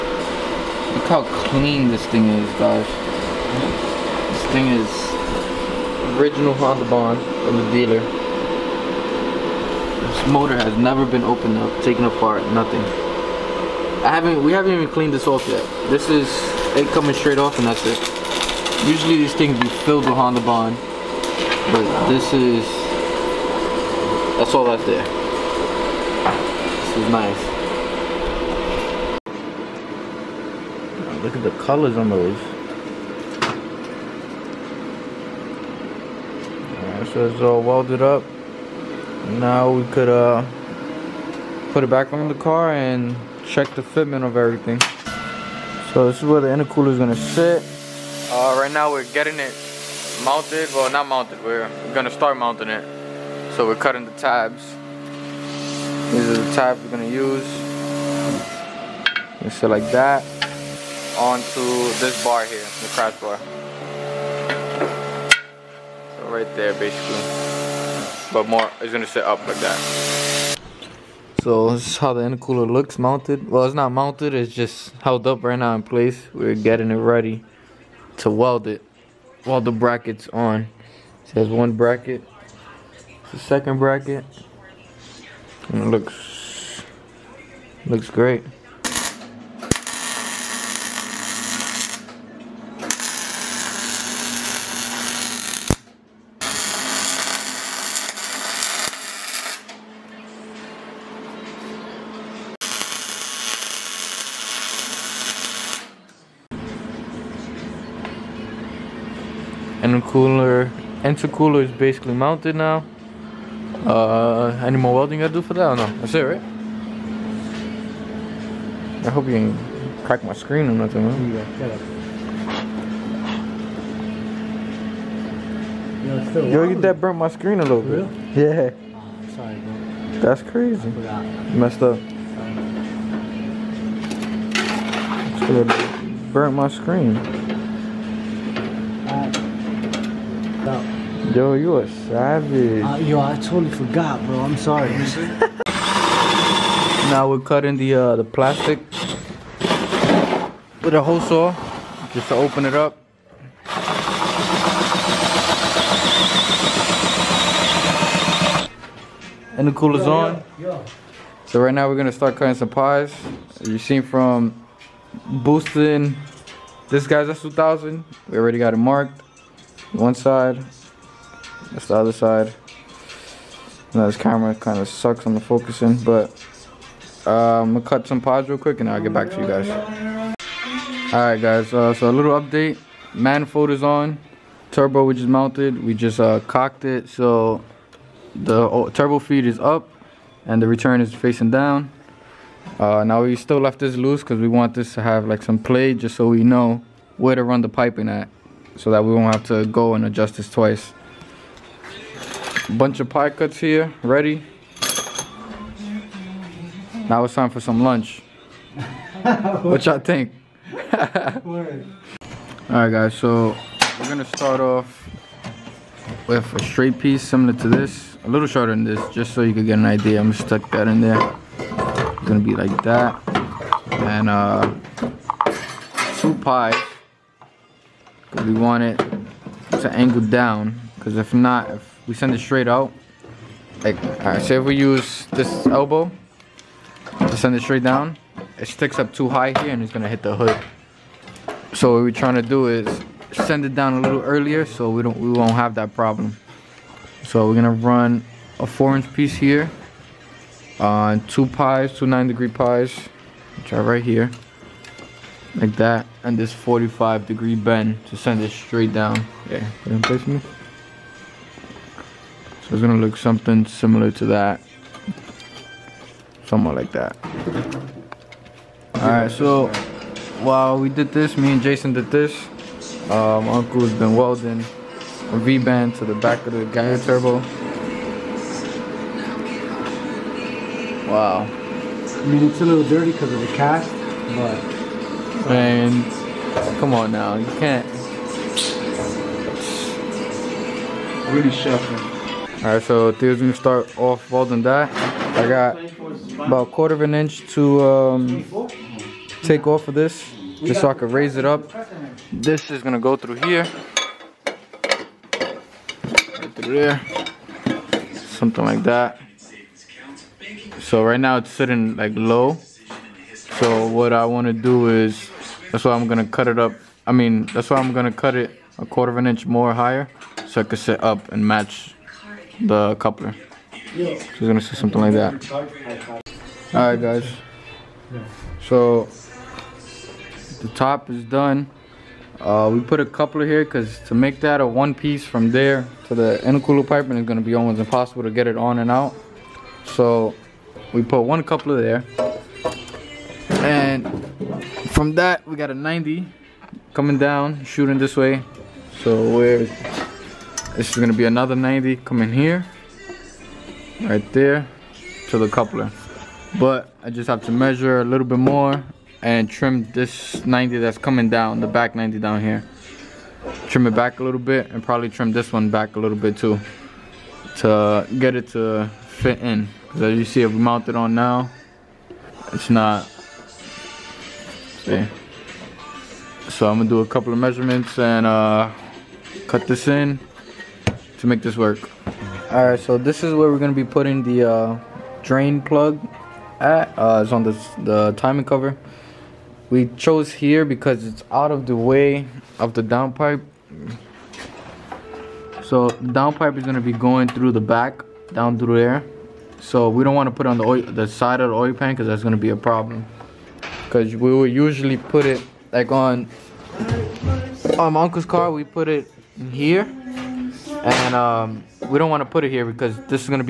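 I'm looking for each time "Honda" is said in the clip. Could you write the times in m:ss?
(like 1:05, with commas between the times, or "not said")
0:06, 0:20.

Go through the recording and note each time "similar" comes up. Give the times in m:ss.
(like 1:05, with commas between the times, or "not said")
3:37, 4:23.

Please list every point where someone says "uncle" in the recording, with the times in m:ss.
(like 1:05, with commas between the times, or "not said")
4:33, 6:48.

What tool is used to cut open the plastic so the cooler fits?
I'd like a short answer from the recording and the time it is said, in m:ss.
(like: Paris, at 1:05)
a hole saw, at 2:31.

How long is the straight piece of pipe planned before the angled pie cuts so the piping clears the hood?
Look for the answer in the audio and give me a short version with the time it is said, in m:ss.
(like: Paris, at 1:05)
4 inches, at 4:08.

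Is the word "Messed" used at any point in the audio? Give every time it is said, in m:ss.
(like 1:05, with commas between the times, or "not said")
2:11.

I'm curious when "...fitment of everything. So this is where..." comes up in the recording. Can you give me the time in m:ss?
0:43.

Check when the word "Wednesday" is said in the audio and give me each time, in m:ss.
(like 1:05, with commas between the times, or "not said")
not said.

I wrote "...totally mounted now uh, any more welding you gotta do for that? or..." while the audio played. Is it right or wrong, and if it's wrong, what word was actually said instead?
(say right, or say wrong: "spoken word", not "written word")
wrong: "basically", not "totally".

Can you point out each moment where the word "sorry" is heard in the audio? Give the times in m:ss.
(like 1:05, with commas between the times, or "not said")
2:09, 2:15, 2:24.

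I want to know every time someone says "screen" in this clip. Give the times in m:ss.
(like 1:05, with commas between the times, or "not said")
2:00, 2:07, 2:16.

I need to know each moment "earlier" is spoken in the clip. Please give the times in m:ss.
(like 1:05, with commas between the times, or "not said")
4:04.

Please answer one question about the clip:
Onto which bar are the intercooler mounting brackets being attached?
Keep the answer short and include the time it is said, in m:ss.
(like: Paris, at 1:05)
the crash bar, at 1:02.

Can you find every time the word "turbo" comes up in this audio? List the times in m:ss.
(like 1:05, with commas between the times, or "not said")
3:04, 3:08, 4:36.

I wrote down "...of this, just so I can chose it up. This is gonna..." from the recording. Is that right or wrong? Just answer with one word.
wrong.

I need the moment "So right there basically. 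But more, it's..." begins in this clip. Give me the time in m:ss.
1:06.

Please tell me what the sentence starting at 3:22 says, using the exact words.
Bunch of pie cuts here, ready.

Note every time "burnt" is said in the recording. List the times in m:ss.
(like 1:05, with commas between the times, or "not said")
2:06, 2:16.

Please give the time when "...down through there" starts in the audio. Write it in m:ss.
6:38.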